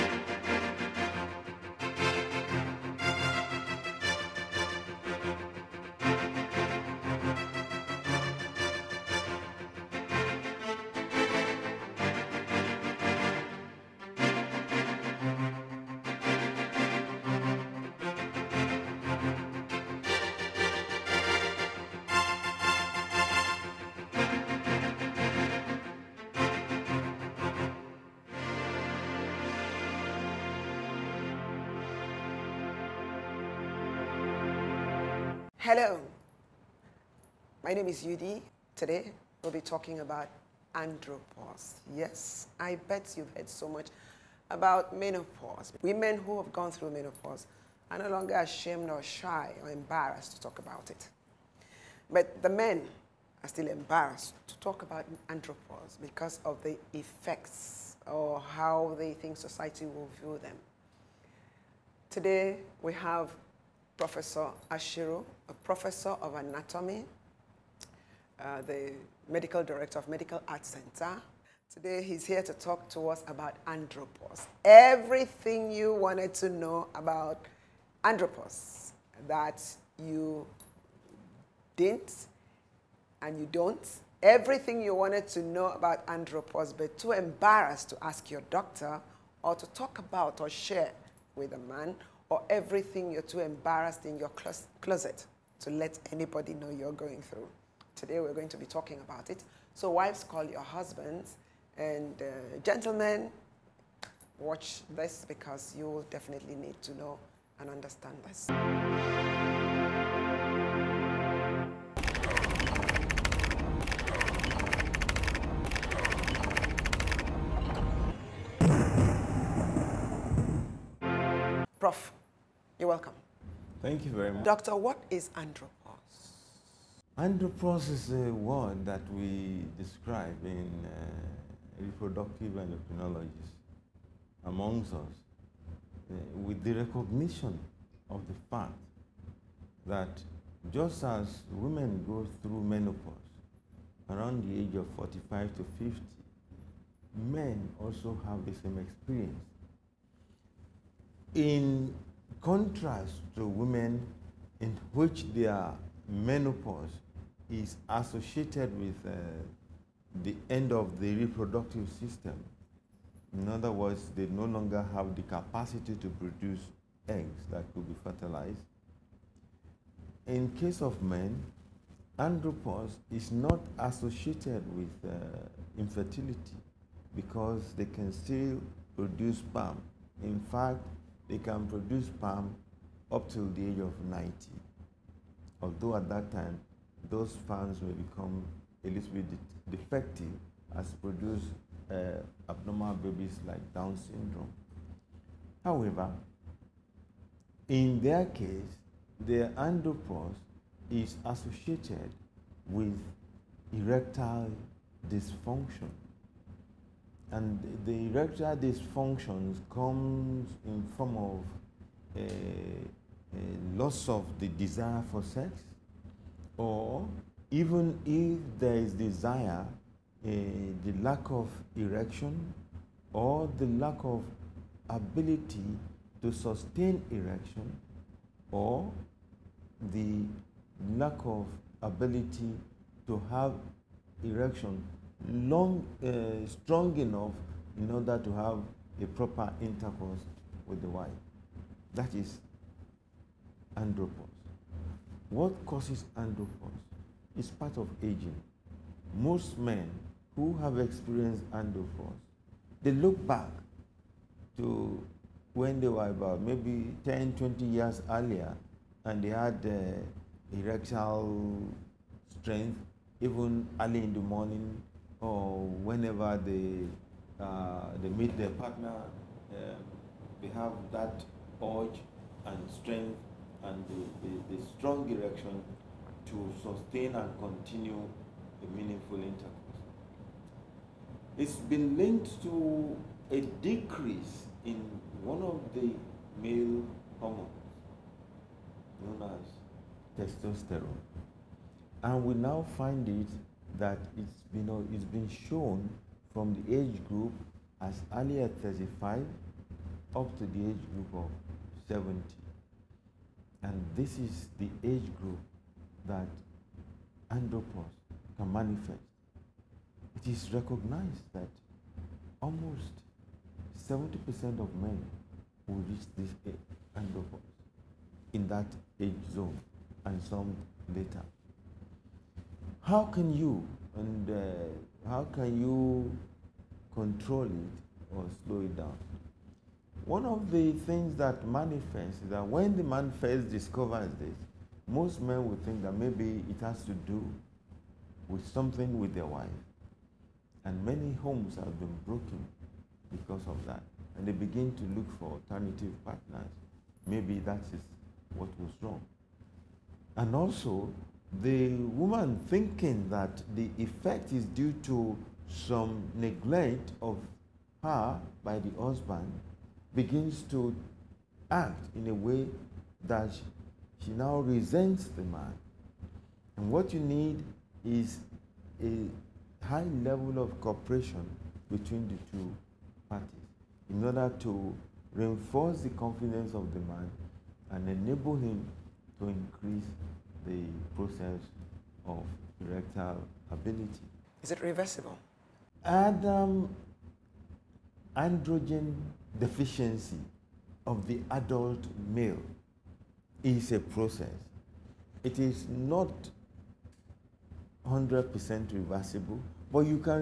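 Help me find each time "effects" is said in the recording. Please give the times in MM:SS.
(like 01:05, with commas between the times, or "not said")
00:56, 05:53.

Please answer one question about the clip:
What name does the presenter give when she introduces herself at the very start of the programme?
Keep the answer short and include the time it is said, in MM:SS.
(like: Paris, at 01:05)
Udy, at 00:38.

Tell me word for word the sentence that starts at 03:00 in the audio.
In fact, they can produce sperm up till the age of 90.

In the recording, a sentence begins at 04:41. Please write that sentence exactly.
It's been linked to a decrease in one of the male hormones known as testosterone.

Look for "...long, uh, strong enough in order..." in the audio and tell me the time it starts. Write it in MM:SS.
03:55.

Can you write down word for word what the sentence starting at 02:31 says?
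In contrast to women in which their menopause is associated with uh, the end of the reproductive system.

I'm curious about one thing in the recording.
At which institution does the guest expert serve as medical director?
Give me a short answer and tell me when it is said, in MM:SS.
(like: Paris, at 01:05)
Medical Arts Center, at 01:10.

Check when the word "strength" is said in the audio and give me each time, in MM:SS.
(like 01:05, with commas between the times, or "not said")
04:22, 04:32.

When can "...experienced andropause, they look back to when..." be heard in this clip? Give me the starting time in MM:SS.
04:10.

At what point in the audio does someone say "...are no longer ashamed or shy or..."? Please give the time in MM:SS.
00:47.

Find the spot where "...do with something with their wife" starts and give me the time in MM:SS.
05:37.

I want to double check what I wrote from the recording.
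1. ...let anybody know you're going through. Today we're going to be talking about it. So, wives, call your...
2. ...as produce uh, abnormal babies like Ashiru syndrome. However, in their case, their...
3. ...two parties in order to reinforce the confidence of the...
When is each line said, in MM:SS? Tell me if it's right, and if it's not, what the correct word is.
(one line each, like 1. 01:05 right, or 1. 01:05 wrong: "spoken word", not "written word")
1. 01:35 right
2. 03:10 wrong: "Down", not "Ashiru"
3. 06:12 right.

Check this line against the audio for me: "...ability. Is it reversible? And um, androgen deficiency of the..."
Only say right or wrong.
right.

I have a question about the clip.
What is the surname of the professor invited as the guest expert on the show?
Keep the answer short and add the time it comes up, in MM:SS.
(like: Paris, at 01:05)
Ashiru, at 01:04.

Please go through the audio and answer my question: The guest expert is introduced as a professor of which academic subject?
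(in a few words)
Anatomy.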